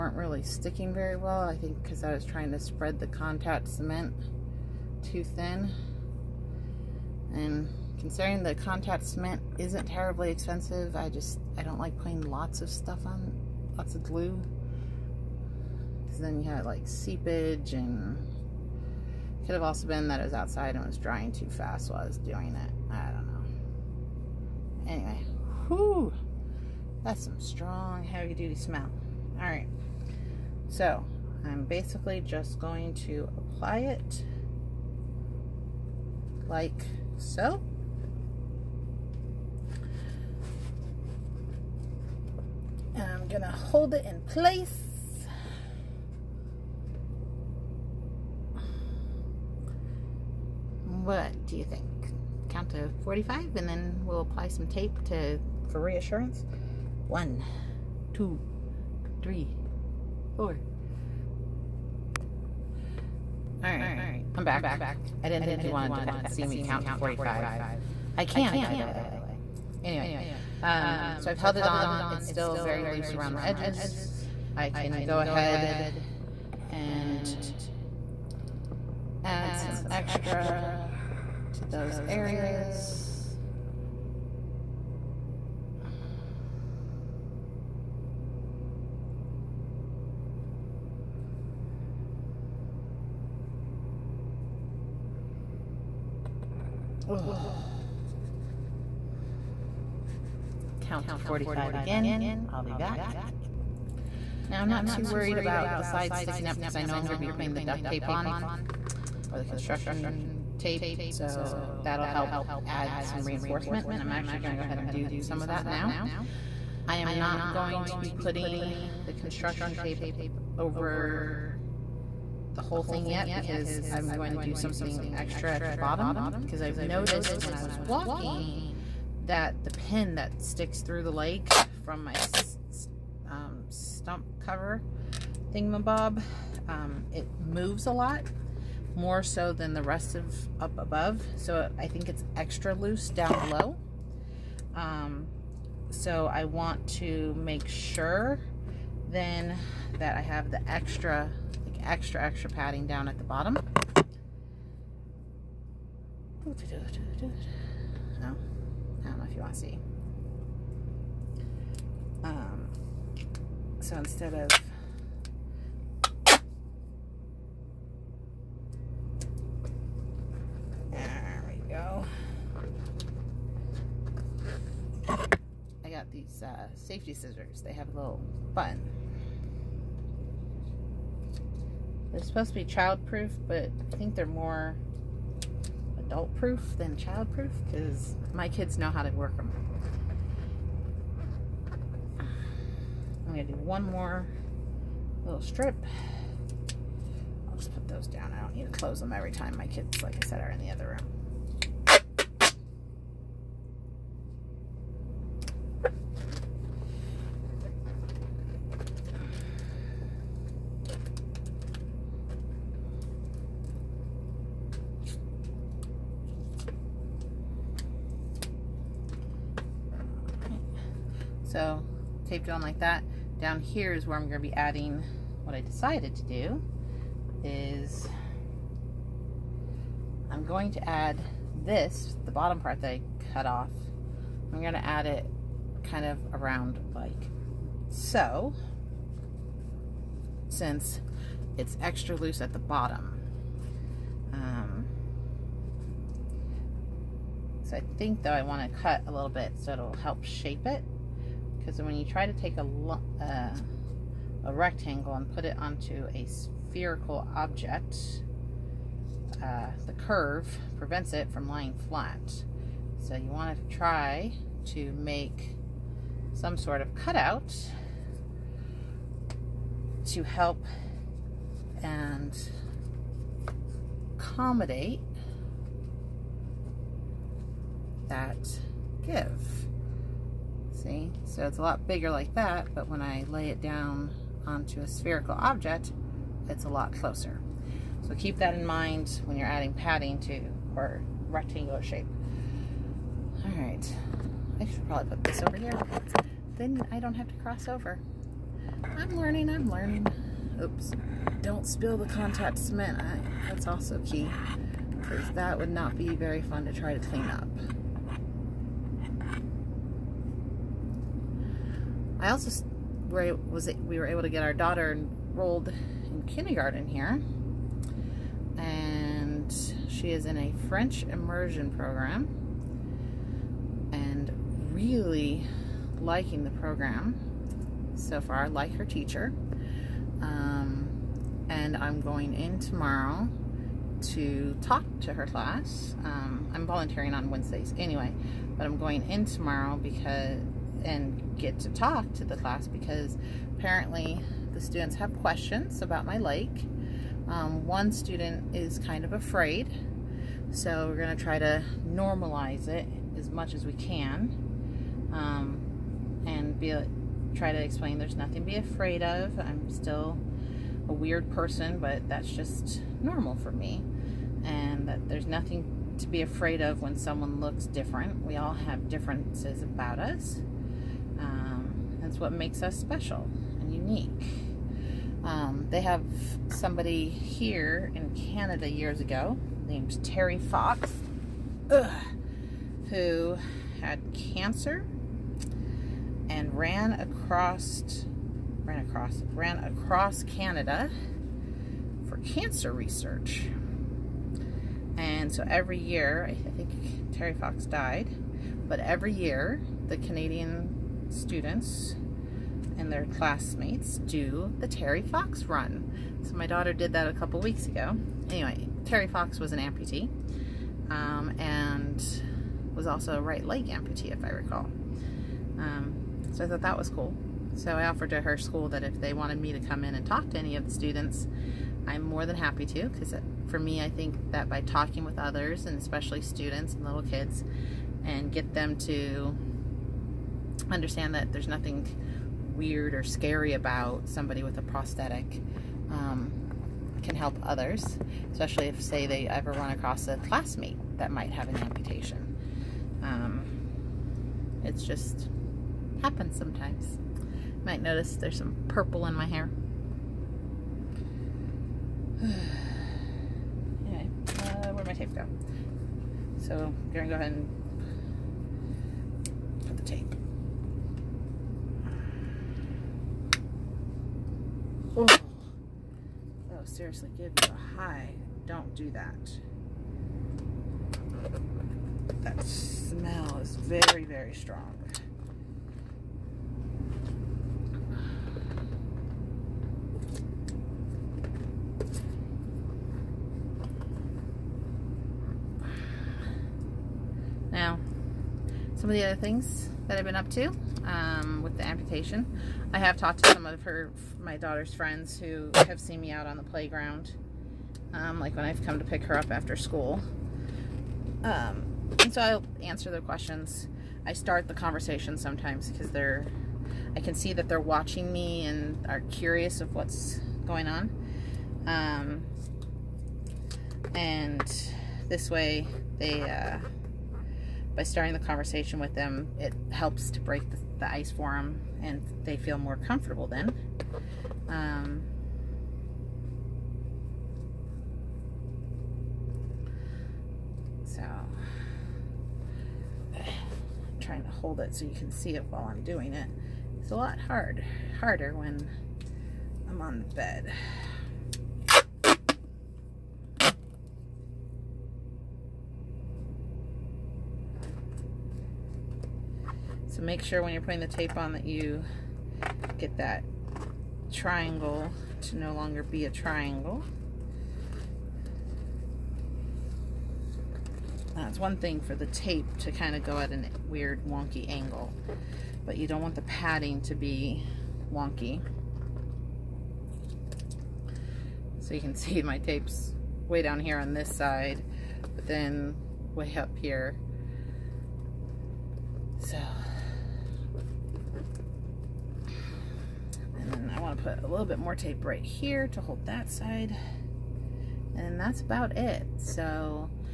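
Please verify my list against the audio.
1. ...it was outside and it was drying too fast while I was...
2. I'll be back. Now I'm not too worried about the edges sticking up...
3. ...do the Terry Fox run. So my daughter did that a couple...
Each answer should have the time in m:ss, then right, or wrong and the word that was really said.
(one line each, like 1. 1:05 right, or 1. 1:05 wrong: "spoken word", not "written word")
1. 0:20 right
2. 1:42 wrong: "sides", not "edges"
3. 6:43 right.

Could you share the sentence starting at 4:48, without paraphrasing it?
So keep that in mind when you're adding padding to or rectangular shape.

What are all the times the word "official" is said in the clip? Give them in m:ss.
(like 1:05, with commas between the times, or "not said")
not said.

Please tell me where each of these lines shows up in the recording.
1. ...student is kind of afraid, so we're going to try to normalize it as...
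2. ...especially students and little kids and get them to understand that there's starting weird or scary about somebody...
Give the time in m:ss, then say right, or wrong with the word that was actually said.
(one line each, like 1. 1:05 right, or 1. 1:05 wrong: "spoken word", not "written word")
1. 5:47 right
2. 7:05 wrong: "nothing", not "starting".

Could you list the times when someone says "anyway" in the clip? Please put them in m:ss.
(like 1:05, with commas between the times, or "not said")
0:24, 1:09, 5:37, 6:48, 7:33.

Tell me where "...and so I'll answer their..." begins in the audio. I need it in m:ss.
8:22.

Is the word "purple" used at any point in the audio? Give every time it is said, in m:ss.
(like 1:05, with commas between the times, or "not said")
7:28.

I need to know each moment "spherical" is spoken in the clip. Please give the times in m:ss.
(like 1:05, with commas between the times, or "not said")
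4:16, 4:44.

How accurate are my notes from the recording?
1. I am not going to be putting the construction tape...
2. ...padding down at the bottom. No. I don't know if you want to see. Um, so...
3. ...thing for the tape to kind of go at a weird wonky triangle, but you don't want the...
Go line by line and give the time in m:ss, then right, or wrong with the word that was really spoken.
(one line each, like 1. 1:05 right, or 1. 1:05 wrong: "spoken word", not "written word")
1. 1:56 right
2. 2:32 right
3. 9:21 wrong: "angle", not "triangle".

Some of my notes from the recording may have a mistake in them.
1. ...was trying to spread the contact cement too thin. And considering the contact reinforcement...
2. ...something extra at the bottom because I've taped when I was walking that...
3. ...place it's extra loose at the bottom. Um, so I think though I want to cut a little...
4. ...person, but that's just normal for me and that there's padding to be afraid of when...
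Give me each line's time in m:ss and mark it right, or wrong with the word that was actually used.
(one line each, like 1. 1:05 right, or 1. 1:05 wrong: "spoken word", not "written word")
1. 0:02 wrong: "cement", not "reinforcement"
2. 2:04 wrong: "noticed", not "taped"
3. 4:00 wrong: "since", not "place"
4. 6:01 wrong: "nothing", not "padding".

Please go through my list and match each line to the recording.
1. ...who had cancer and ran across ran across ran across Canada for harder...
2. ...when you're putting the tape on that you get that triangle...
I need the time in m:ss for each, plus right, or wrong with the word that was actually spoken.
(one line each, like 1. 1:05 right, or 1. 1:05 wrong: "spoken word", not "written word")
1. 6:22 wrong: "cancer", not "harder"
2. 9:10 right.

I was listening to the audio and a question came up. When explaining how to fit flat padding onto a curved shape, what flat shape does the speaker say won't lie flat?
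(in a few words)
rectangle.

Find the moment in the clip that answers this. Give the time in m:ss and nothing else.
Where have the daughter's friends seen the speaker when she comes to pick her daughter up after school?
8:16.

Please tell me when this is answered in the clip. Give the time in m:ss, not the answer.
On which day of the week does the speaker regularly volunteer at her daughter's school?
5:37.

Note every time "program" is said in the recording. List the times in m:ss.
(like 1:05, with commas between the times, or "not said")
5:21, 5:26.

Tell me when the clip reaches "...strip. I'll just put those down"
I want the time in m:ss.
3:15.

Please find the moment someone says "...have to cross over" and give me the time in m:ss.
4:57.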